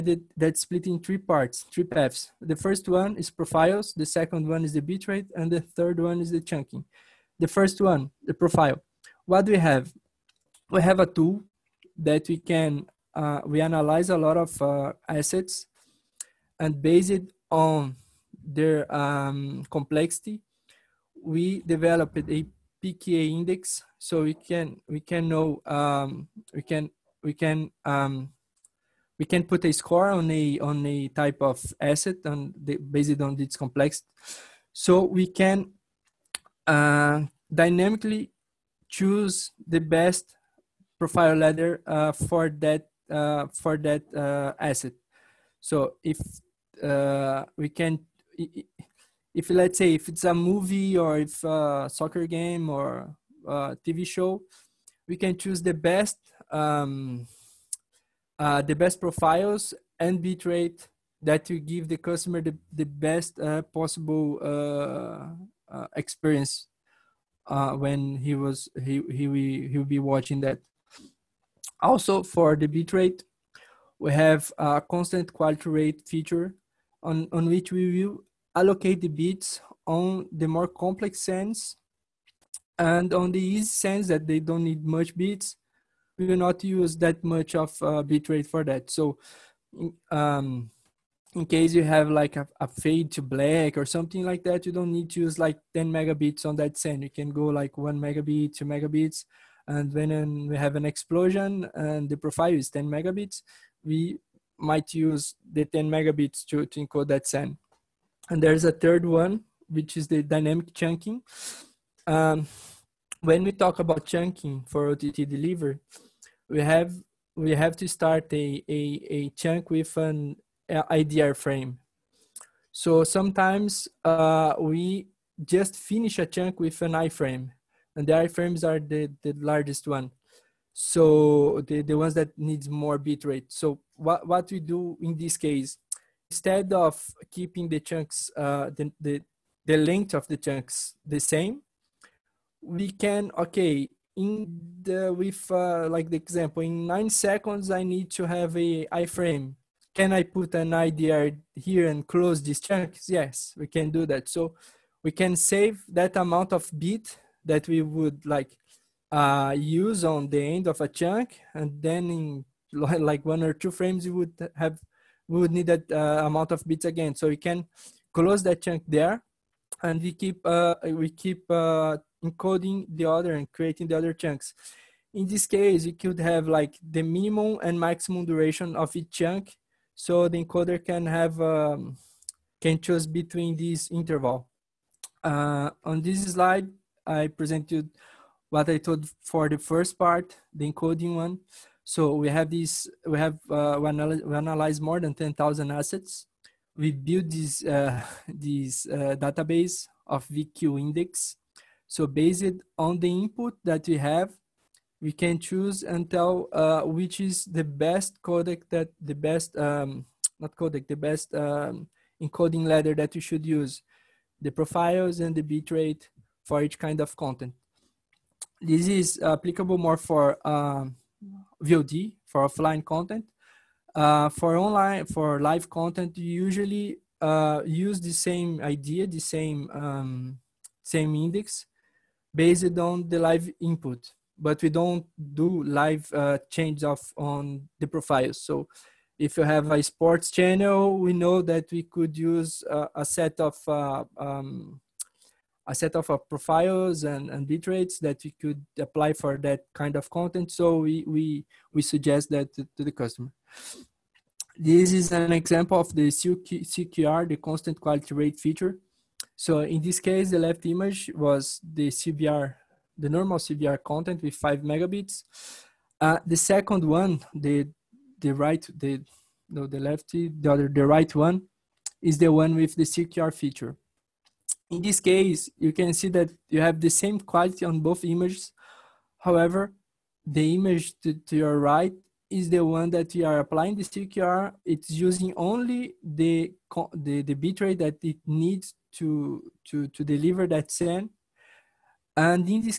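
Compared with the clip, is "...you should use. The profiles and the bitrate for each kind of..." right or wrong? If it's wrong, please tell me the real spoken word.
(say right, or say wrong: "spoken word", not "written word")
right.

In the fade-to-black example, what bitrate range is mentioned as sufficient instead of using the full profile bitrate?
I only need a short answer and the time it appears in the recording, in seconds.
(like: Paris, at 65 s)
1 to 2 megabits, at 97 s.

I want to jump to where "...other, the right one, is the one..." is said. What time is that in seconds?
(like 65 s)
270 s.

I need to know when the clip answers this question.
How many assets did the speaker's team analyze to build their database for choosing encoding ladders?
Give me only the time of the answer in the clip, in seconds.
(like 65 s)
194 s.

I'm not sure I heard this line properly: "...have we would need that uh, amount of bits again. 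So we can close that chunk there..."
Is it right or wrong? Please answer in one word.
right.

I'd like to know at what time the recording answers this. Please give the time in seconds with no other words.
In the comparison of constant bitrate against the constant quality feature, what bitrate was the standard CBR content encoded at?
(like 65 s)
264 s.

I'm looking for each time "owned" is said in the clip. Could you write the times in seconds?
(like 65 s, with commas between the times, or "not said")
not said.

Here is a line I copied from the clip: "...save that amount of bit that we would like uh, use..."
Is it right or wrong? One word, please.
right.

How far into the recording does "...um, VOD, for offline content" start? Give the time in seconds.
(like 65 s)
220 s.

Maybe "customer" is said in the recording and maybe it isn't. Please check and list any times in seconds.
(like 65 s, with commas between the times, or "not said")
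61 s, 252 s.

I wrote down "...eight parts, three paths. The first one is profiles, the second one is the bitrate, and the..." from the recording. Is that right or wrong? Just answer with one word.
wrong.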